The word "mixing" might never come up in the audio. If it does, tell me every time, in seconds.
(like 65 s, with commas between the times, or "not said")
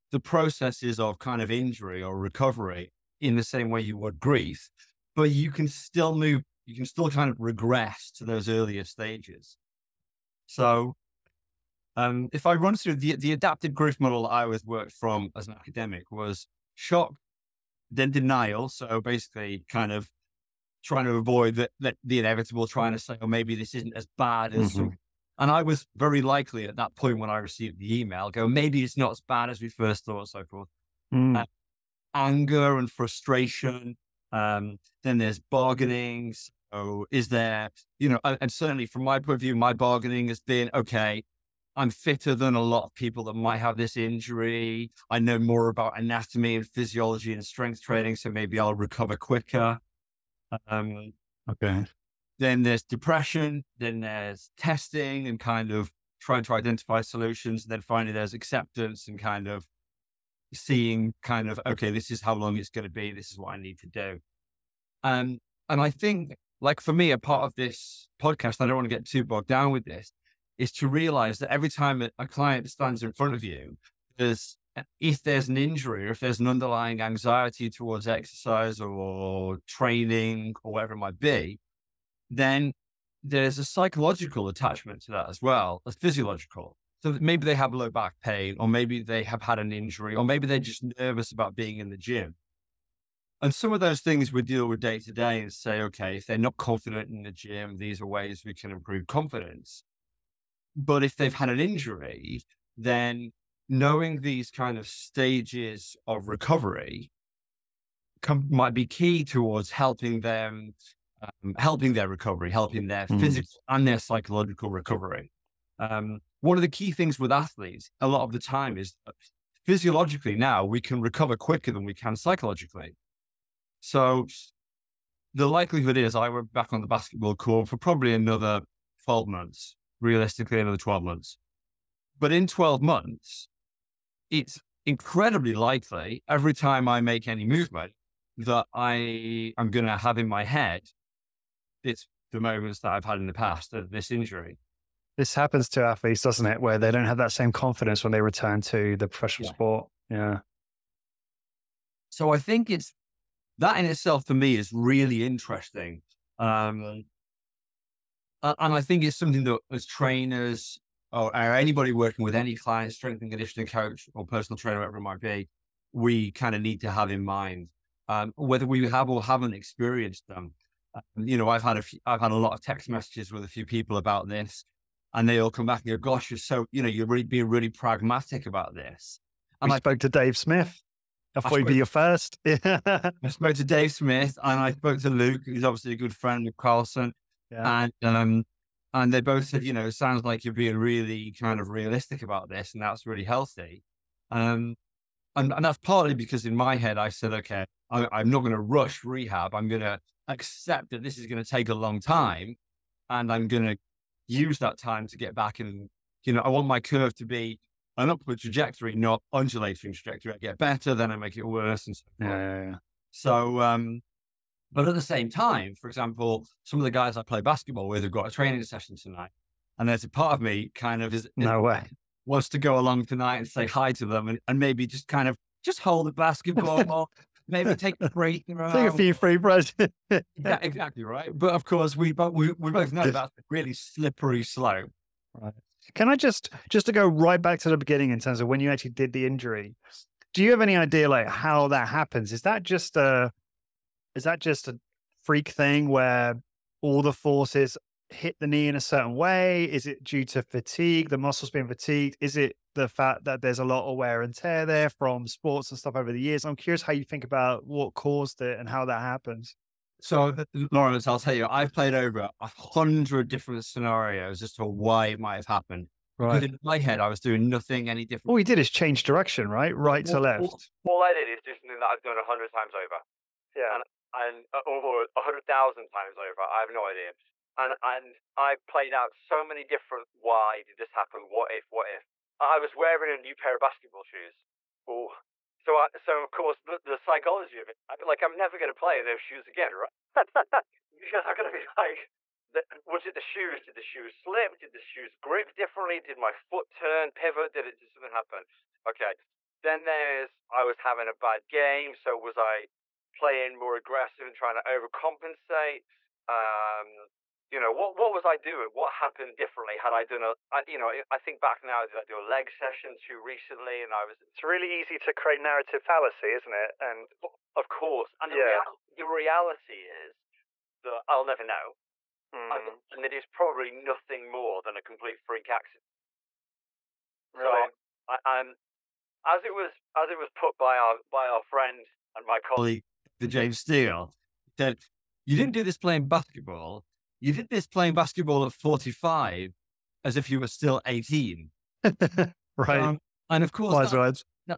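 not said.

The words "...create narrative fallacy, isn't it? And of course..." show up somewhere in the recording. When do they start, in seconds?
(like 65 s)
315 s.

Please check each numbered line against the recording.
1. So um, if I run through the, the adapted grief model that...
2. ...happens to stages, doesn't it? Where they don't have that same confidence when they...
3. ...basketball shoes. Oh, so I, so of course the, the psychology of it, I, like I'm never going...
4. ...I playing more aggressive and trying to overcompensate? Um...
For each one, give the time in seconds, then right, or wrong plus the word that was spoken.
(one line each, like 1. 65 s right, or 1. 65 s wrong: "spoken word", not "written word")
1. 10 s right
2. 145 s wrong: "athletes", not "stages"
3. 283 s right
4. 302 s right.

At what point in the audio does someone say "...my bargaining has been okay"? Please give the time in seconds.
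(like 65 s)
39 s.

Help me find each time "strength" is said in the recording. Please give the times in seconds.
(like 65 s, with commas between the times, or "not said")
47 s, 162 s.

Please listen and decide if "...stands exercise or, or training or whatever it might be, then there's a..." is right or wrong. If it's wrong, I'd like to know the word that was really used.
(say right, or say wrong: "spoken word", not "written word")
wrong: "towards", not "stands".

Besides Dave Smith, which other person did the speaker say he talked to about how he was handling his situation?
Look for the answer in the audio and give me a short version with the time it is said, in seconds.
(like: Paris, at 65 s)
Luke, at 185 s.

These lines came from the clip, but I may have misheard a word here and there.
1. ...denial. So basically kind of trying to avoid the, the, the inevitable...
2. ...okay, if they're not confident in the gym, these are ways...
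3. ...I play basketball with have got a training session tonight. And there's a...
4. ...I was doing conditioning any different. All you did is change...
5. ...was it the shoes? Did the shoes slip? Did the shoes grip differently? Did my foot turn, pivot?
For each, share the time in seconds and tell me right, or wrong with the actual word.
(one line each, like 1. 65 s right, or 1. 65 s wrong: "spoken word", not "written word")
1. 18 s right
2. 95 s right
3. 217 s right
4. 267 s wrong: "nothing", not "conditioning"
5. 292 s right.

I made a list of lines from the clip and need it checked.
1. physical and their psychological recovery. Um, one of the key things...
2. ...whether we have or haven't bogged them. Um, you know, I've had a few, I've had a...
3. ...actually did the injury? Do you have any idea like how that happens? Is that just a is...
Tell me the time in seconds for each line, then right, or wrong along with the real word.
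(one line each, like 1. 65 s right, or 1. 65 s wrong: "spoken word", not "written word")
1. 113 s right
2. 168 s wrong: "experienced", not "bogged"
3. 238 s right.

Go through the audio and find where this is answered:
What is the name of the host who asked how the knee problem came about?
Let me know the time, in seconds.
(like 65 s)
260 s.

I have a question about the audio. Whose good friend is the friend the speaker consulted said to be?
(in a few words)
Carlson.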